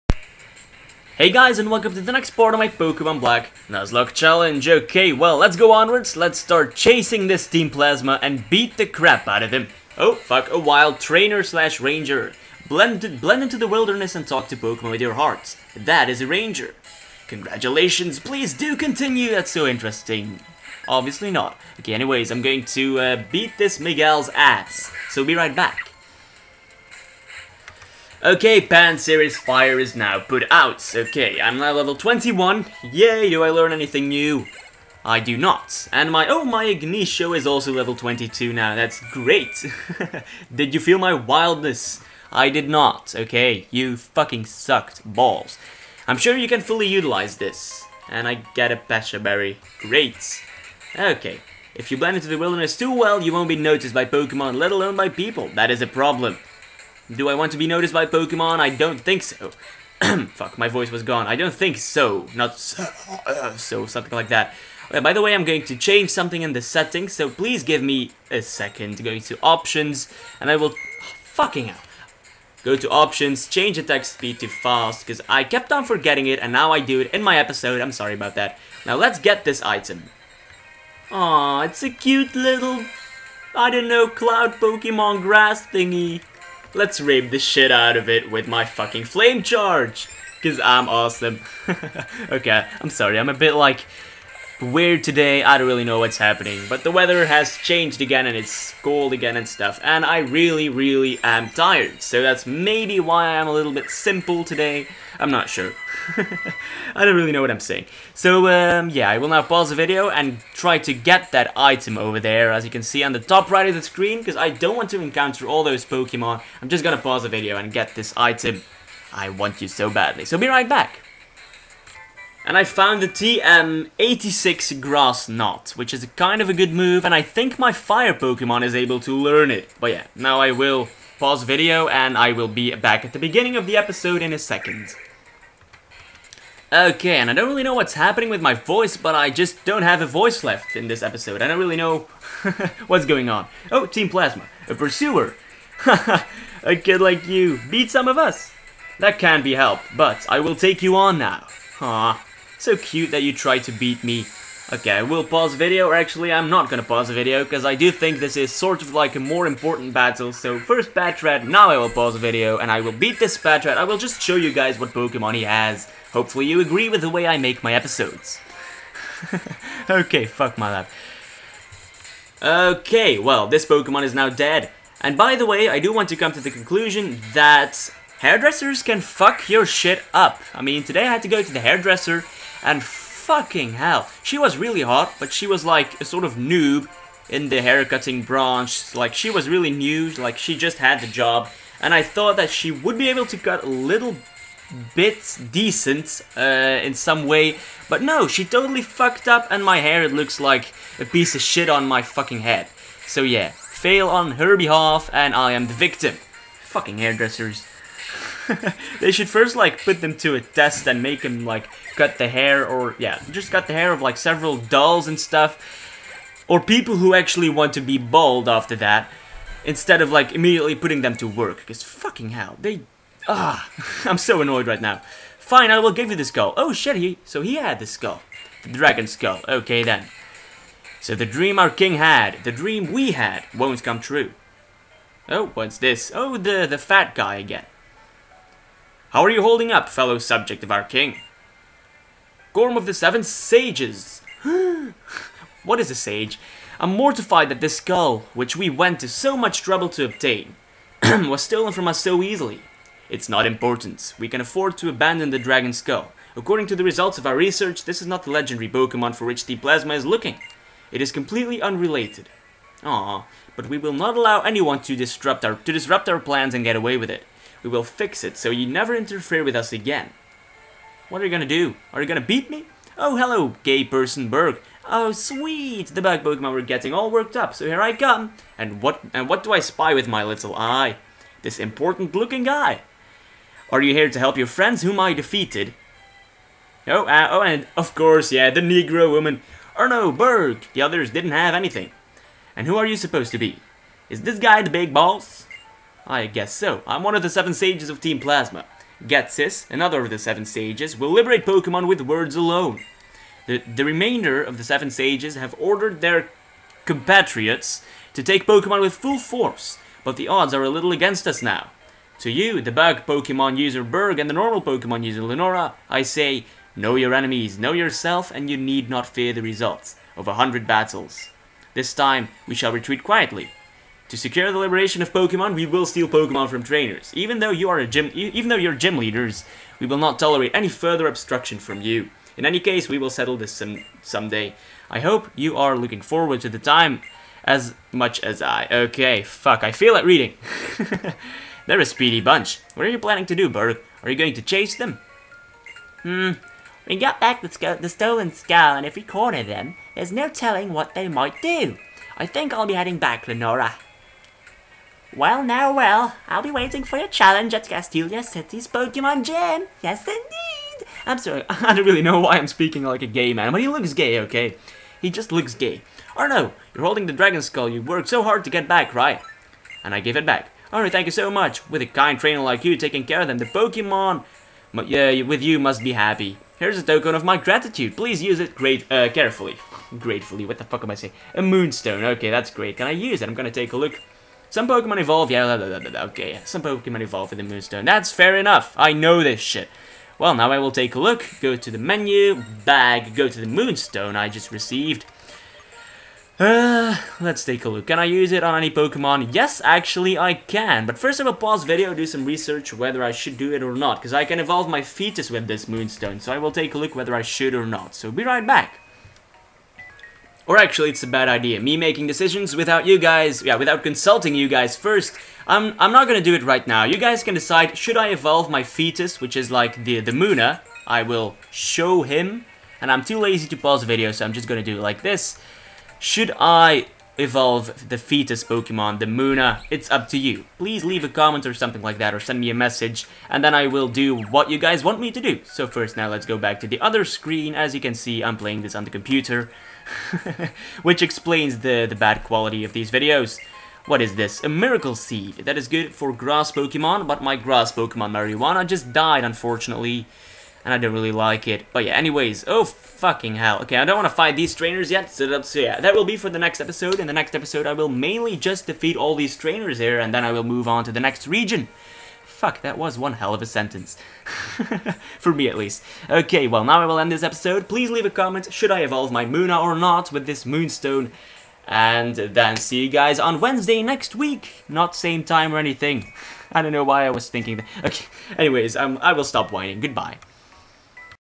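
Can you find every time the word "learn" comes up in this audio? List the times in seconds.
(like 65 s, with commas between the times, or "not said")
33 s, 129 s.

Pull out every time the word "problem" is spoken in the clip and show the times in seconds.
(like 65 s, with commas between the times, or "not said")
55 s.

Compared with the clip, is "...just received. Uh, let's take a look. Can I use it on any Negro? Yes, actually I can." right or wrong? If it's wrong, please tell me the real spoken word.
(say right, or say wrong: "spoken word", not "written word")
wrong: "Pokemon", not "Negro".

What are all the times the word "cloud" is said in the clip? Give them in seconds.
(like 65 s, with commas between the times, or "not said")
84 s.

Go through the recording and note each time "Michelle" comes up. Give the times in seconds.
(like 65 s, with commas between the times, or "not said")
not said.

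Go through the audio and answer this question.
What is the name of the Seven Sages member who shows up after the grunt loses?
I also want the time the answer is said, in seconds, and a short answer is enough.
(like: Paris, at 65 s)
Gorm, at 242 s.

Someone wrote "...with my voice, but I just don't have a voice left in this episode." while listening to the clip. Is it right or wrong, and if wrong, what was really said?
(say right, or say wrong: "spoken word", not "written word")
right.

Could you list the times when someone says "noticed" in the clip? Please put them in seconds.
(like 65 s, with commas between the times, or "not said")
53 s, 57 s.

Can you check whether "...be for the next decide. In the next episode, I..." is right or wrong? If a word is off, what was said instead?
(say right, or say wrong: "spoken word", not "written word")
wrong: "episode", not "decide".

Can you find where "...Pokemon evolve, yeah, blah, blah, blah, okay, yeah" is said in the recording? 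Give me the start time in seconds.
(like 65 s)
384 s.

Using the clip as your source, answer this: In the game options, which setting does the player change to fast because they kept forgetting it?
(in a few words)
Attack speed.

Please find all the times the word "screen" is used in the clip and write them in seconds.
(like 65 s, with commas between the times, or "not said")
113 s, 437 s.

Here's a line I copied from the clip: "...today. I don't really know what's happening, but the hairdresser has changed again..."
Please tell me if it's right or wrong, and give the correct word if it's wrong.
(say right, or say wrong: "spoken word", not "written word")
wrong: "weather", not "hairdresser".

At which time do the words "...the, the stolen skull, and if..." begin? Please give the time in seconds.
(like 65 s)
347 s.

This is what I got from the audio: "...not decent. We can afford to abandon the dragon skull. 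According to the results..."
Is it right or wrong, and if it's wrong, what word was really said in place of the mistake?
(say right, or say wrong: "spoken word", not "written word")
wrong: "important", not "decent".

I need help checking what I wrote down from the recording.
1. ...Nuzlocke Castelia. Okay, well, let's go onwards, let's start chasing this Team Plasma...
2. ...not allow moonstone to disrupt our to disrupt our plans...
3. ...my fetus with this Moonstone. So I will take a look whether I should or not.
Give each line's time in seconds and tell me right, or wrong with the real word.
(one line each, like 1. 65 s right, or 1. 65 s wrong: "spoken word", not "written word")
1. 3 s wrong: "Challenge", not "Castelia"
2. 263 s wrong: "anyone", not "moonstone"
3. 404 s right.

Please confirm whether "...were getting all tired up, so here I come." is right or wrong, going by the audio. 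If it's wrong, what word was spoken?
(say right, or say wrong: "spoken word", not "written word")
wrong: "worked", not "tired".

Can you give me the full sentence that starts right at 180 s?
I mean, today I had to go to the hairdresser and fucking hell.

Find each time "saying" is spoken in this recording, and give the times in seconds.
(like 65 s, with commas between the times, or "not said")
107 s, 380 s.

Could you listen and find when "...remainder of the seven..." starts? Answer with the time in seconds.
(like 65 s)
303 s.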